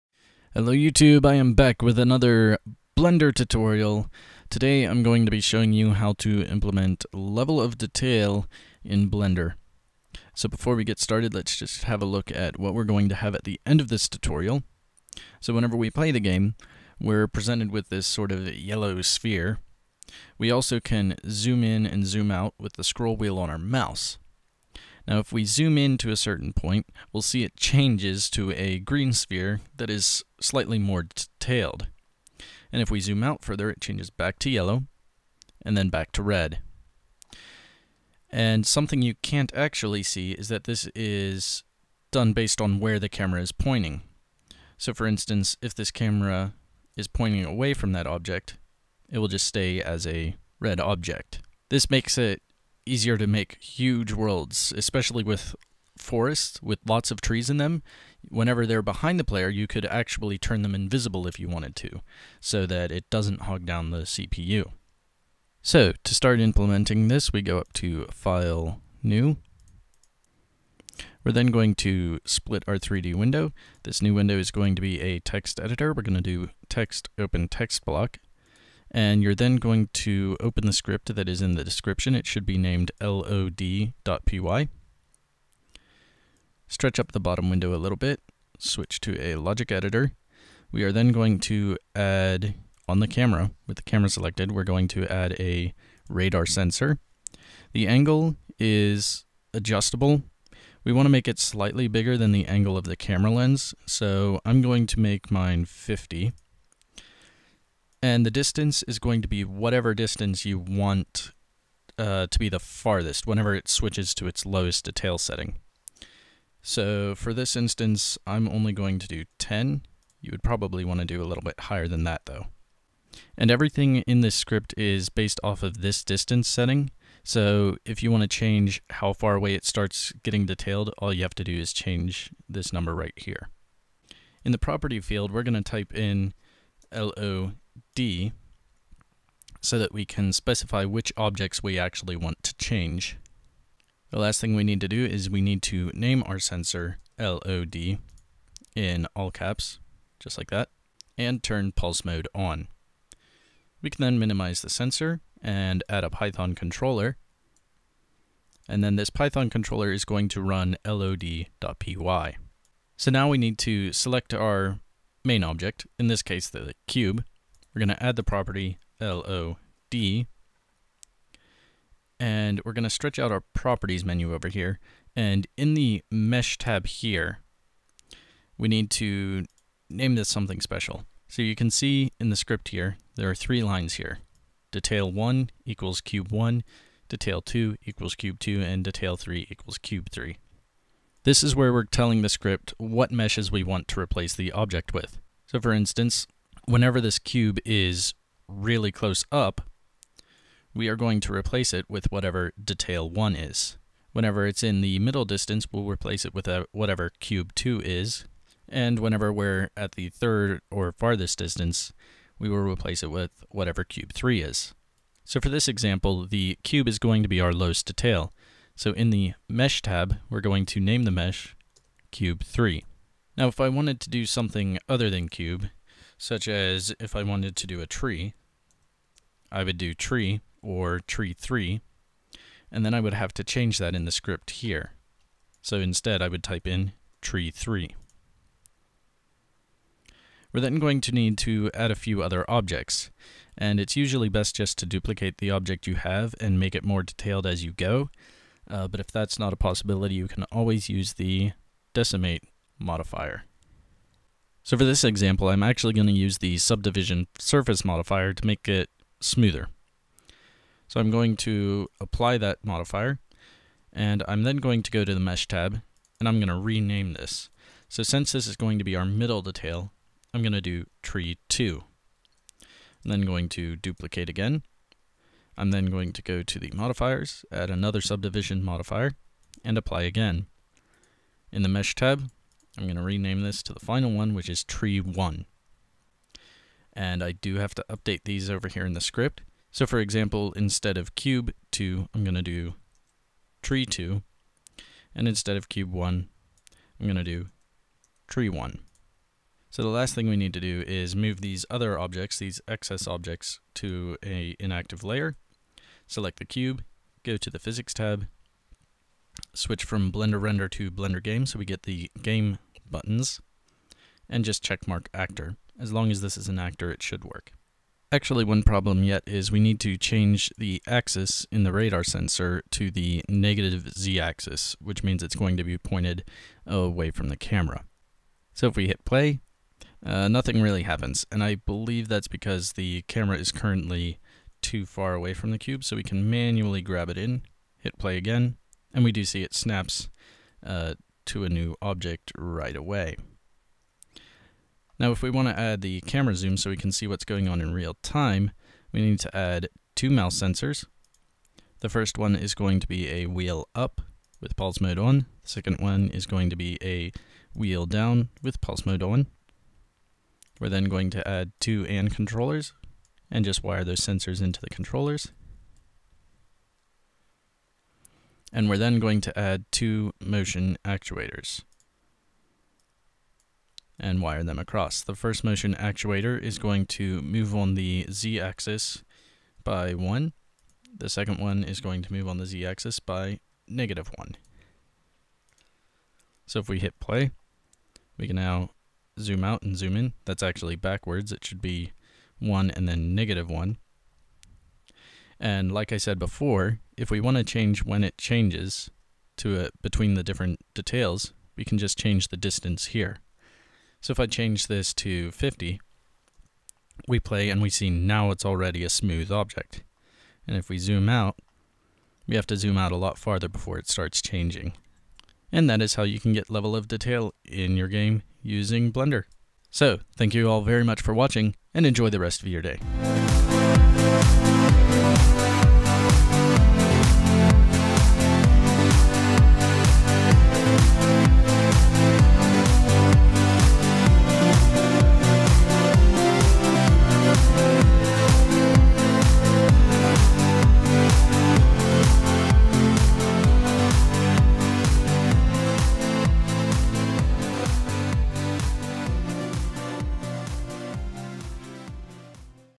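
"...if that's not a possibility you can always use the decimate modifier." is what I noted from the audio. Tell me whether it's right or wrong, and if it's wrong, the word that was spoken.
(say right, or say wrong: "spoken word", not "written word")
right.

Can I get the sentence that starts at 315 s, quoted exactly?
As long as this is an actor, it should work.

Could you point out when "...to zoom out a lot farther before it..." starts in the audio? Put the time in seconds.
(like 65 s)
412 s.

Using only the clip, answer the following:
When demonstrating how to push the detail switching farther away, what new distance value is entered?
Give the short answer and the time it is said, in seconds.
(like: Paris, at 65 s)
50, at 404 s.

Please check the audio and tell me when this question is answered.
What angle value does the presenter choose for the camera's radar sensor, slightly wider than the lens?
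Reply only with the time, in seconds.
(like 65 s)
104 s.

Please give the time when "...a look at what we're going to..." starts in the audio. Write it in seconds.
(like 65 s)
12 s.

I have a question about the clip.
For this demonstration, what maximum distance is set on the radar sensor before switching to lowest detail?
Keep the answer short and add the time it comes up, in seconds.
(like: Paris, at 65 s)
10, at 118 s.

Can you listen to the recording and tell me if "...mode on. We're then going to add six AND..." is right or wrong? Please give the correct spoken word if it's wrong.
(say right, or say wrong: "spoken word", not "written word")
wrong: "two", not "six".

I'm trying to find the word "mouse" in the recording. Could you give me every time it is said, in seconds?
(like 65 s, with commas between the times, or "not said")
23 s, 350 s.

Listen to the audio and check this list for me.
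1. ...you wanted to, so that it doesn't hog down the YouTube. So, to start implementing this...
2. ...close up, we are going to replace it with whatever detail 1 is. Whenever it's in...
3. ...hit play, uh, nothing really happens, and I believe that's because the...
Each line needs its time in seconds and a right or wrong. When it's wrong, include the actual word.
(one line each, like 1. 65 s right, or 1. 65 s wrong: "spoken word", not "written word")
1. 61 s wrong: "CPU", not "YouTube"
2. 198 s right
3. 328 s right.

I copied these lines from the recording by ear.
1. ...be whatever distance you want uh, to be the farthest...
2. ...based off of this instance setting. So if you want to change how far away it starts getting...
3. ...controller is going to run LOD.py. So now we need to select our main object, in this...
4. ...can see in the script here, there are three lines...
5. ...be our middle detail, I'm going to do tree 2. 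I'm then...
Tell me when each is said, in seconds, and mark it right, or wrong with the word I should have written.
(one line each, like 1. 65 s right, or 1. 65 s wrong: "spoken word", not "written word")
1. 109 s right
2. 125 s wrong: "distance", not "instance"
3. 159 s right
4. 181 s right
5. 268 s right.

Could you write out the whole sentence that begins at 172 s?
And we're going to stretch out our properties menu over here.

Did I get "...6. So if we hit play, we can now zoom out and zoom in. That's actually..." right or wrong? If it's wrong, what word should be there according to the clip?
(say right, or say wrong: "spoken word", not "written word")
wrong: "1", not "6".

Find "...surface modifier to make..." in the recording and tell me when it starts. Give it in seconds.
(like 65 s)
257 s.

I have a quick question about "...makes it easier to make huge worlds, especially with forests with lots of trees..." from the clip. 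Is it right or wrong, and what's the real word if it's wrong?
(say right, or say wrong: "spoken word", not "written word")
right.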